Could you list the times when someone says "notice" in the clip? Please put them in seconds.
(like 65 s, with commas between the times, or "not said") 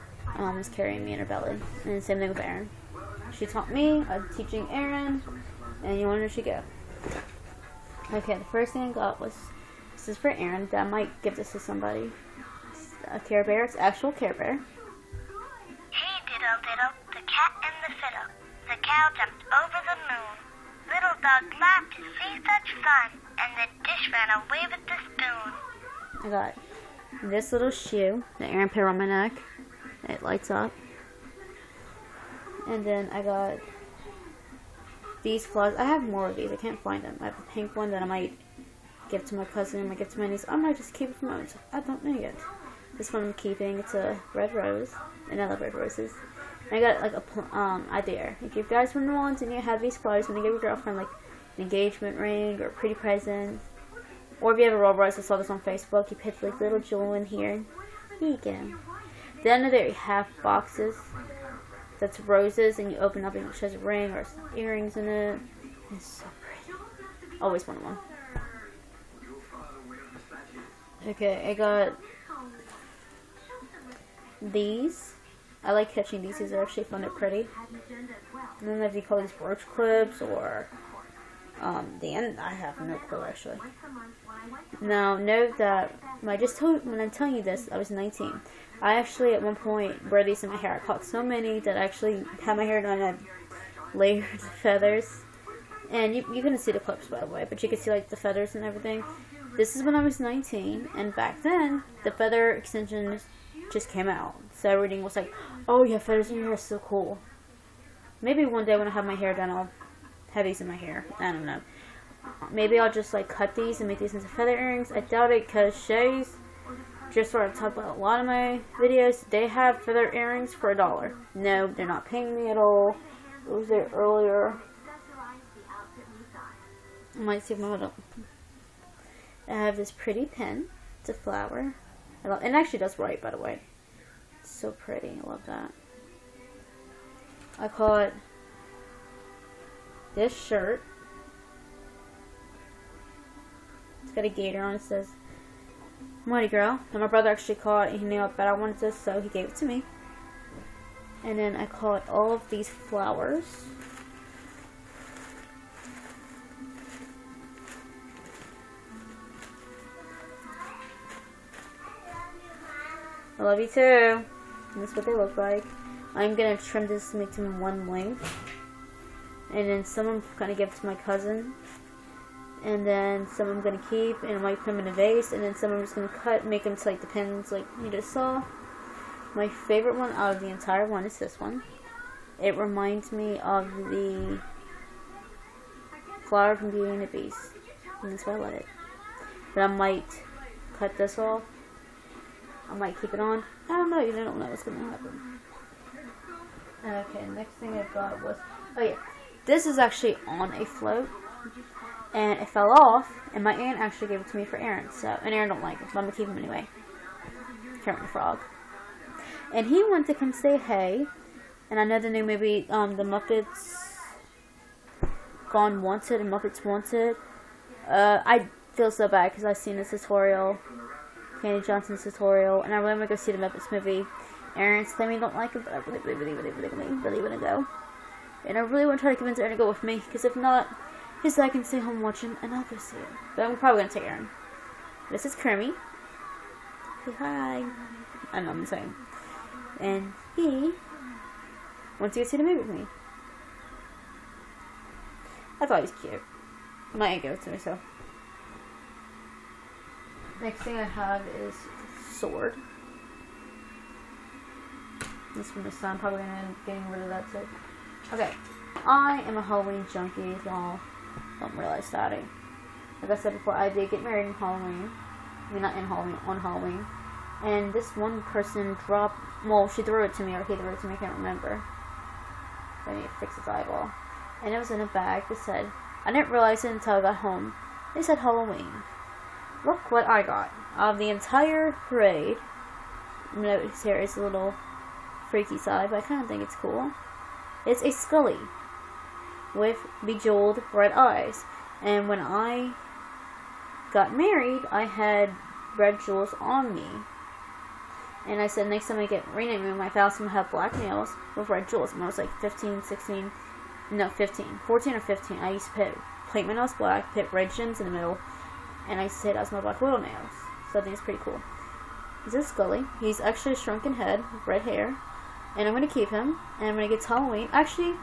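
283 s.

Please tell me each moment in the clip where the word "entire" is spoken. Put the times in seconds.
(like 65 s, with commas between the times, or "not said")
180 s, 281 s.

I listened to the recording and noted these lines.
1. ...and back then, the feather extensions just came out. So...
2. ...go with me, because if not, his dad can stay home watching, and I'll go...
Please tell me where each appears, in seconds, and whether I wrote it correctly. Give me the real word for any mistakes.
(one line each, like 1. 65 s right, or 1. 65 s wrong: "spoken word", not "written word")
1. 100 s right
2. 229 s right.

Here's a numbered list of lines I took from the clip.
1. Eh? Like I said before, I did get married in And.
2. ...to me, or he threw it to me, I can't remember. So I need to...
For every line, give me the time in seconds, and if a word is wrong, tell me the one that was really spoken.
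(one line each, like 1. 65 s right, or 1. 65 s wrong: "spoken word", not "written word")
1. 262 s wrong: "Halloween", not "And"
2. 270 s right.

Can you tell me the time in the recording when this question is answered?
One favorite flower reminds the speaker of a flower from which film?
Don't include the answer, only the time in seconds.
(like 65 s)
186 s.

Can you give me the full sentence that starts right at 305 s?
I used to put plate my nails black, put red gems in the middle, and I said I smell black oil nails.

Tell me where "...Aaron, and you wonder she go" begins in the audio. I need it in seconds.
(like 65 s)
4 s.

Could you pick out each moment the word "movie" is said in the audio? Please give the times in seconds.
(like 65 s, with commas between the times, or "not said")
212 s, 223 s, 242 s.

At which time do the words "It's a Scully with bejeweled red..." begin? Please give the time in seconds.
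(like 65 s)
287 s.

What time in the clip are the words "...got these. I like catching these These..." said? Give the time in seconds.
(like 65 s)
71 s.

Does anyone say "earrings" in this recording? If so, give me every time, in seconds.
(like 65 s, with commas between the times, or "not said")
64 s, 114 s, 120 s.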